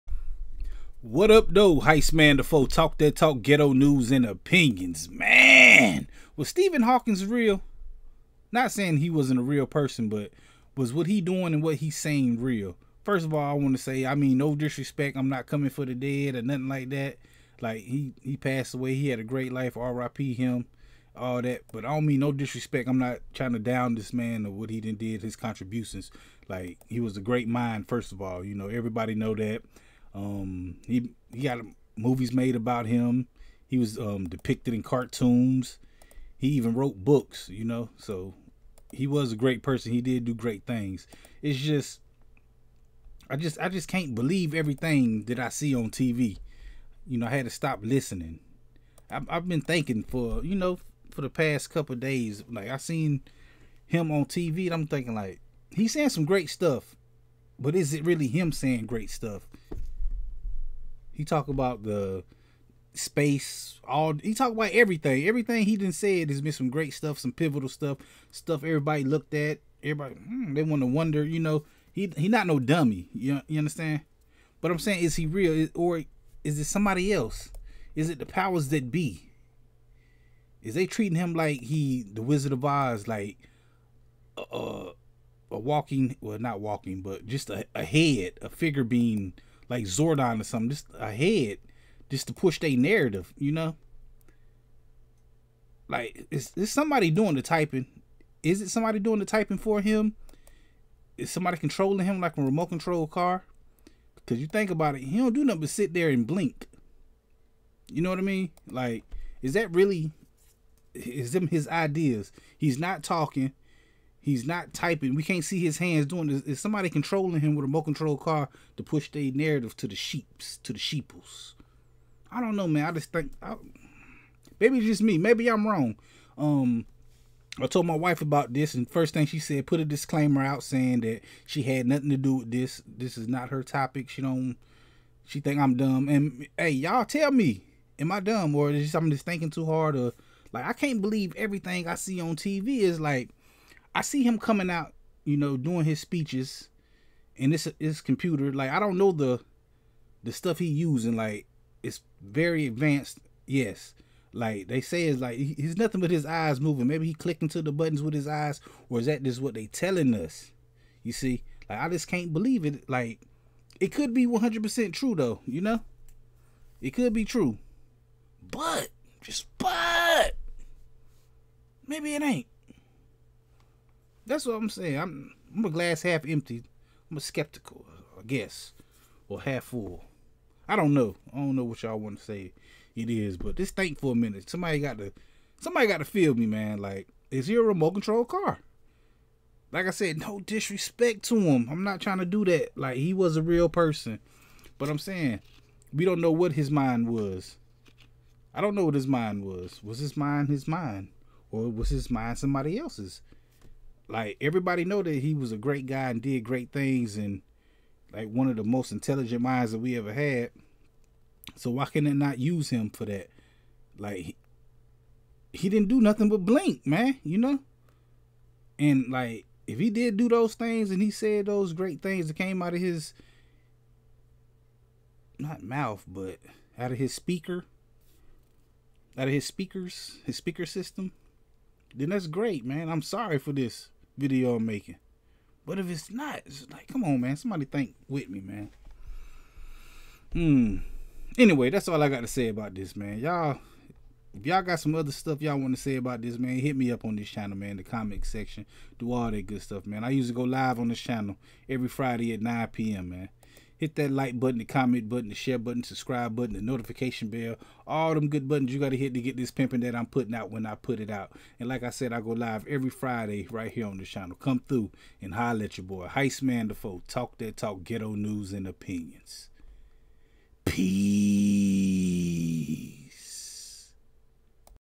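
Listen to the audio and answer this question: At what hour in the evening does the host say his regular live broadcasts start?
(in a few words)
9 p.m.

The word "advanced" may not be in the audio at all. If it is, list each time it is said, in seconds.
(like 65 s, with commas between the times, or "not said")
152 s.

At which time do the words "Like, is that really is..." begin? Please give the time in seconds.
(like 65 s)
108 s.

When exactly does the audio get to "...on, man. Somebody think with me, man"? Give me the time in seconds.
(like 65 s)
237 s.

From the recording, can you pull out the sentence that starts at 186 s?
Like, is he a remote control car?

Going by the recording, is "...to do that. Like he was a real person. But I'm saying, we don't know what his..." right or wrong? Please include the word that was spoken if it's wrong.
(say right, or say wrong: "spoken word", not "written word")
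right.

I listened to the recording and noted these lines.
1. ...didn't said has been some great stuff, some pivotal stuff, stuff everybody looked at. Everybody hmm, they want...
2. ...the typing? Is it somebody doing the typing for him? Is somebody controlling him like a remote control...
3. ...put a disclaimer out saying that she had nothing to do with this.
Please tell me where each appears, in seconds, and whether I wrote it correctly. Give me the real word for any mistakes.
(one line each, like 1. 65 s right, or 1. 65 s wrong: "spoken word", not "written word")
1. 65 s right
2. 97 s right
3. 129 s right.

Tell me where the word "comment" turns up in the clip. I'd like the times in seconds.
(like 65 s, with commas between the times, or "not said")
247 s, 254 s.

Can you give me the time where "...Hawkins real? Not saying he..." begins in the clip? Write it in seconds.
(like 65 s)
6 s.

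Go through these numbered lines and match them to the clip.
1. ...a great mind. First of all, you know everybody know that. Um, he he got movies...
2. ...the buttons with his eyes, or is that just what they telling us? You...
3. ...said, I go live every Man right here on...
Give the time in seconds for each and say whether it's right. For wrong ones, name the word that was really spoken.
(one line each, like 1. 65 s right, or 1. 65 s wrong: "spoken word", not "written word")
1. 27 s right
2. 157 s right
3. 261 s wrong: "Friday", not "Man".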